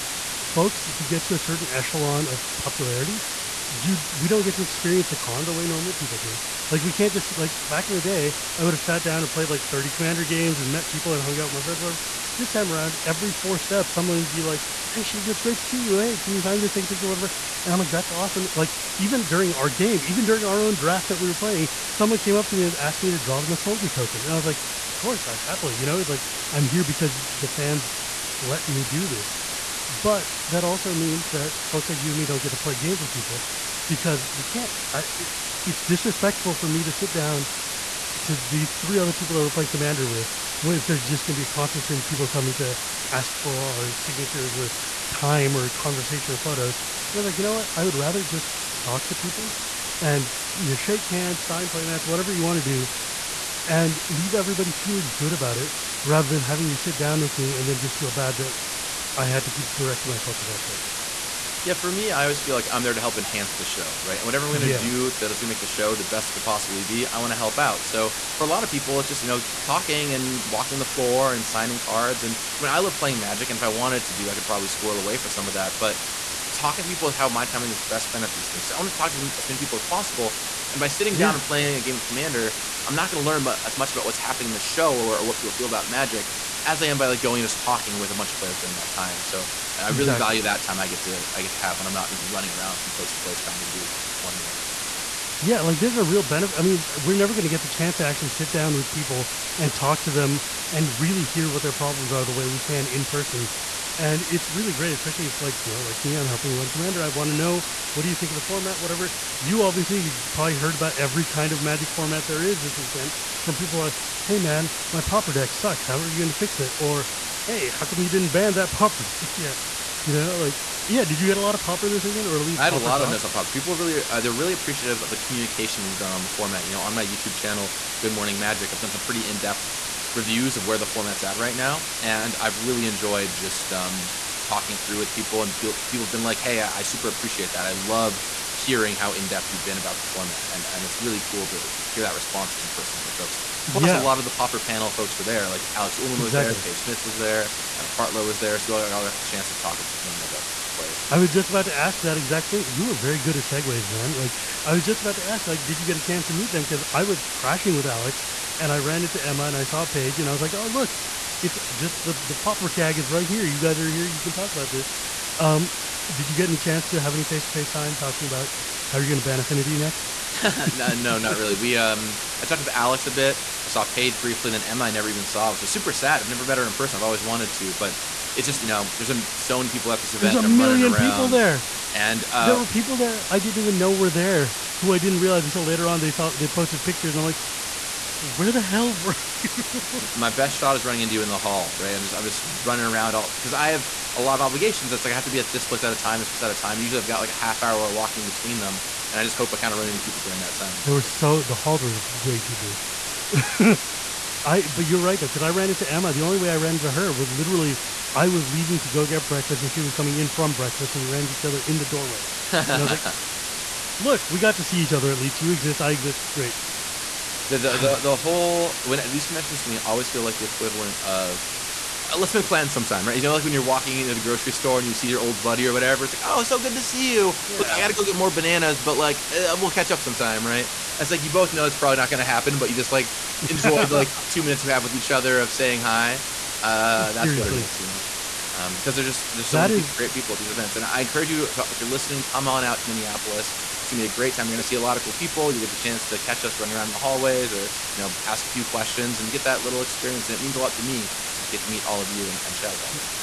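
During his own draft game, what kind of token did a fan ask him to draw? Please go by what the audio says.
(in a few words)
soldier token.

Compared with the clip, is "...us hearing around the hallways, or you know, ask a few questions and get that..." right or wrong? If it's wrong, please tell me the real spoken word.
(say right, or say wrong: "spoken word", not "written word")
wrong: "running", not "hearing".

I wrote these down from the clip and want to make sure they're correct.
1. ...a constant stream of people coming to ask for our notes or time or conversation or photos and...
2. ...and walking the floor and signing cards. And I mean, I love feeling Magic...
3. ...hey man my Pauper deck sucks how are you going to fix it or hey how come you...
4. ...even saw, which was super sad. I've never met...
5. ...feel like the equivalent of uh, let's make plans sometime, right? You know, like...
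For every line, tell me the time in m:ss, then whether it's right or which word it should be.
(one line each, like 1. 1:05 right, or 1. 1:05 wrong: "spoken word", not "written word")
1. 0:41 wrong: "signatures", not "notes"
2. 1:10 wrong: "playing", not "feeling"
3. 1:54 right
4. 2:55 right
5. 3:40 right.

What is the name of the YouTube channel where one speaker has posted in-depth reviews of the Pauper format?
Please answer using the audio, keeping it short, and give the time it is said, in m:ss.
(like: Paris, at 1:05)
Good Morning Magic, at 2:07.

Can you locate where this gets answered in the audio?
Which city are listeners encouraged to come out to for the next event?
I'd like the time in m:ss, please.
4:02.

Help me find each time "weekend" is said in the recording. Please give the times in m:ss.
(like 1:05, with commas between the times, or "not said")
1:52, 2:02.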